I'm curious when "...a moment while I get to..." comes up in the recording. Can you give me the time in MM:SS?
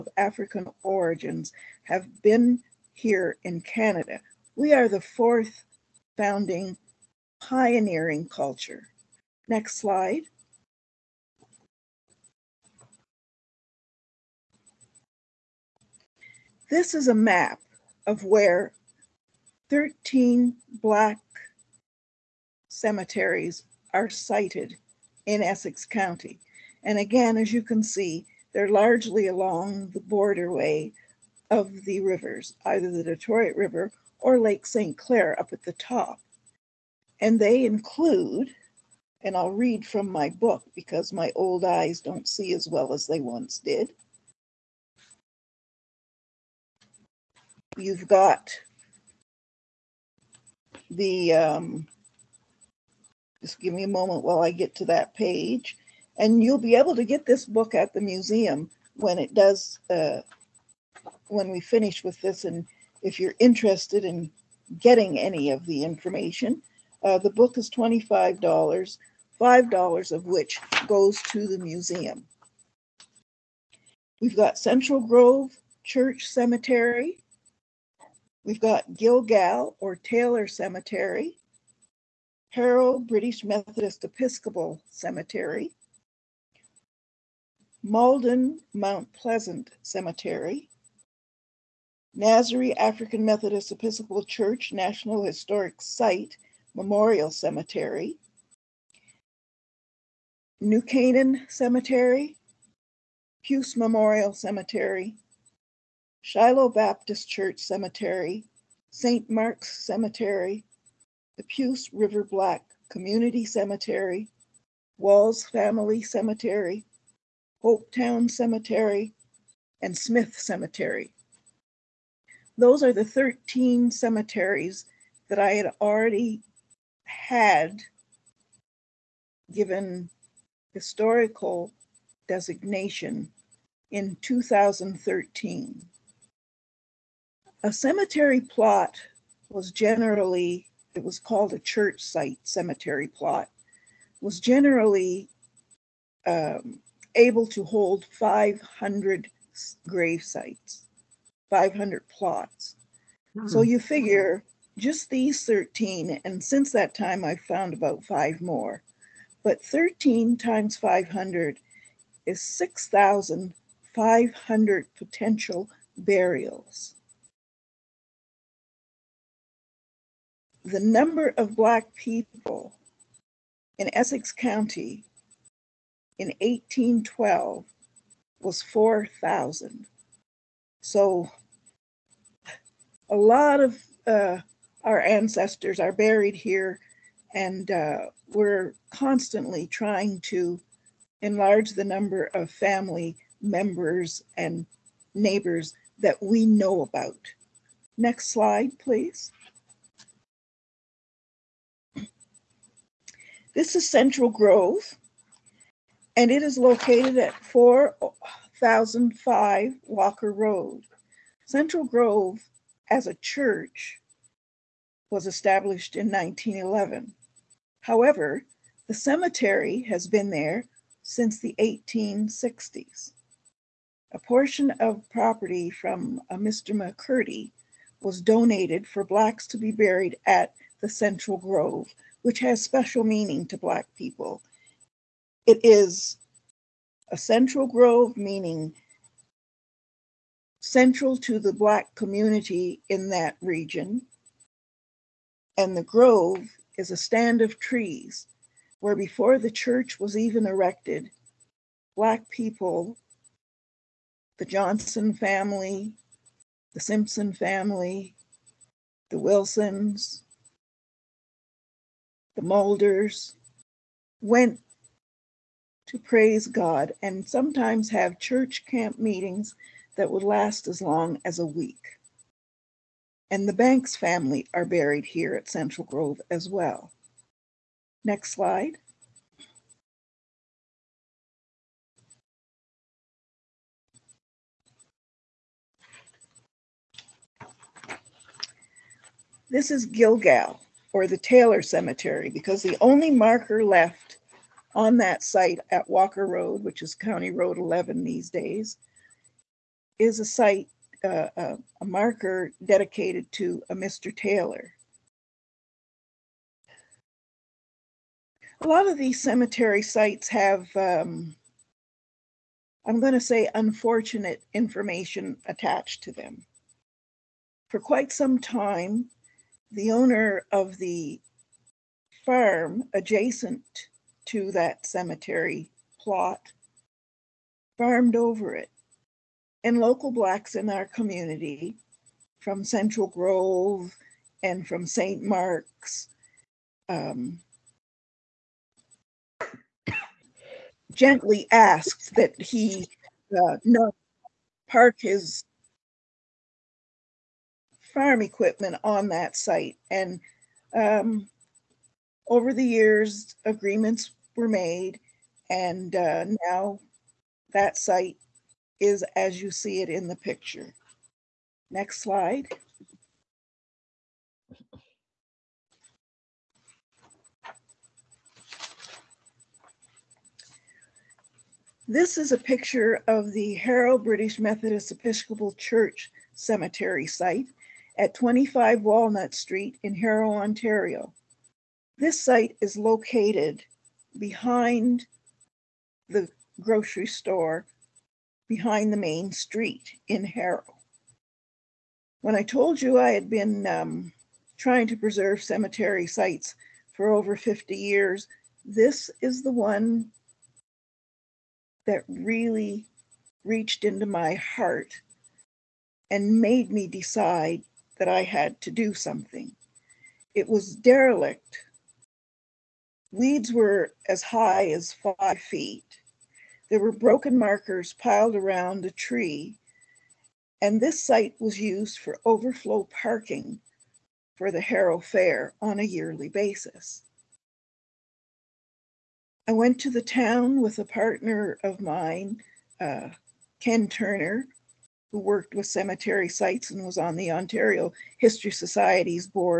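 00:53.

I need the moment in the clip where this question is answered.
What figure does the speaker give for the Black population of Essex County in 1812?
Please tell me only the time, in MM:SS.
02:58.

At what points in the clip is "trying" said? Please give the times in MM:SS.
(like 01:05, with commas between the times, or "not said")
03:09, 06:34.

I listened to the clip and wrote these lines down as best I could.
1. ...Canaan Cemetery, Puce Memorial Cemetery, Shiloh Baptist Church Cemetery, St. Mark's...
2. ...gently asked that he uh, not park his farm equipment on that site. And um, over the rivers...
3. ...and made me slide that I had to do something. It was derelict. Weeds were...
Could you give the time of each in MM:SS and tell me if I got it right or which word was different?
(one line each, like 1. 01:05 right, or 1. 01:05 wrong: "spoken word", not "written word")
1. 01:40 right
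2. 05:40 wrong: "years", not "rivers"
3. 06:46 wrong: "decide", not "slide".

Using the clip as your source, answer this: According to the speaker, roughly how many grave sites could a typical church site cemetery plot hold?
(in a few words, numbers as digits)
500.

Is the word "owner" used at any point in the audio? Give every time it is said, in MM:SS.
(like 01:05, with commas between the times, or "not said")
05:19.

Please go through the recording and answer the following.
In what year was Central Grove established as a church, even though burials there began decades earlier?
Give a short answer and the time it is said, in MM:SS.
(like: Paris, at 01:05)
1911, at 03:36.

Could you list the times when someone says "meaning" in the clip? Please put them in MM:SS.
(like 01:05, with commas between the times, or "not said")
03:53, 03:58.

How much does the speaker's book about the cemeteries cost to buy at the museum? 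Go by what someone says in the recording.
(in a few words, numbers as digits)
$25.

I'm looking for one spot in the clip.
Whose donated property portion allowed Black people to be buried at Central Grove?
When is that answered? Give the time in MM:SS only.
03:46.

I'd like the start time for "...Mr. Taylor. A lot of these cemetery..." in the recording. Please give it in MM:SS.
05:03.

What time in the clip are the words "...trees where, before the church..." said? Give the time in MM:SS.
04:07.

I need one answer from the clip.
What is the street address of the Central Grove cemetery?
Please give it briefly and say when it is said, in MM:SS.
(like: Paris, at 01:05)
4005 Walker Road, at 03:27.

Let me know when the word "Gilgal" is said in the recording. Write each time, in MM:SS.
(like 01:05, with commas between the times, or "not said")
01:18, 04:49.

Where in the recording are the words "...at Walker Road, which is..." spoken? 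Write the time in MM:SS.
04:55.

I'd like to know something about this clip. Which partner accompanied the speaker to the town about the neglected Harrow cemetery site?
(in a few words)
Ken Turner.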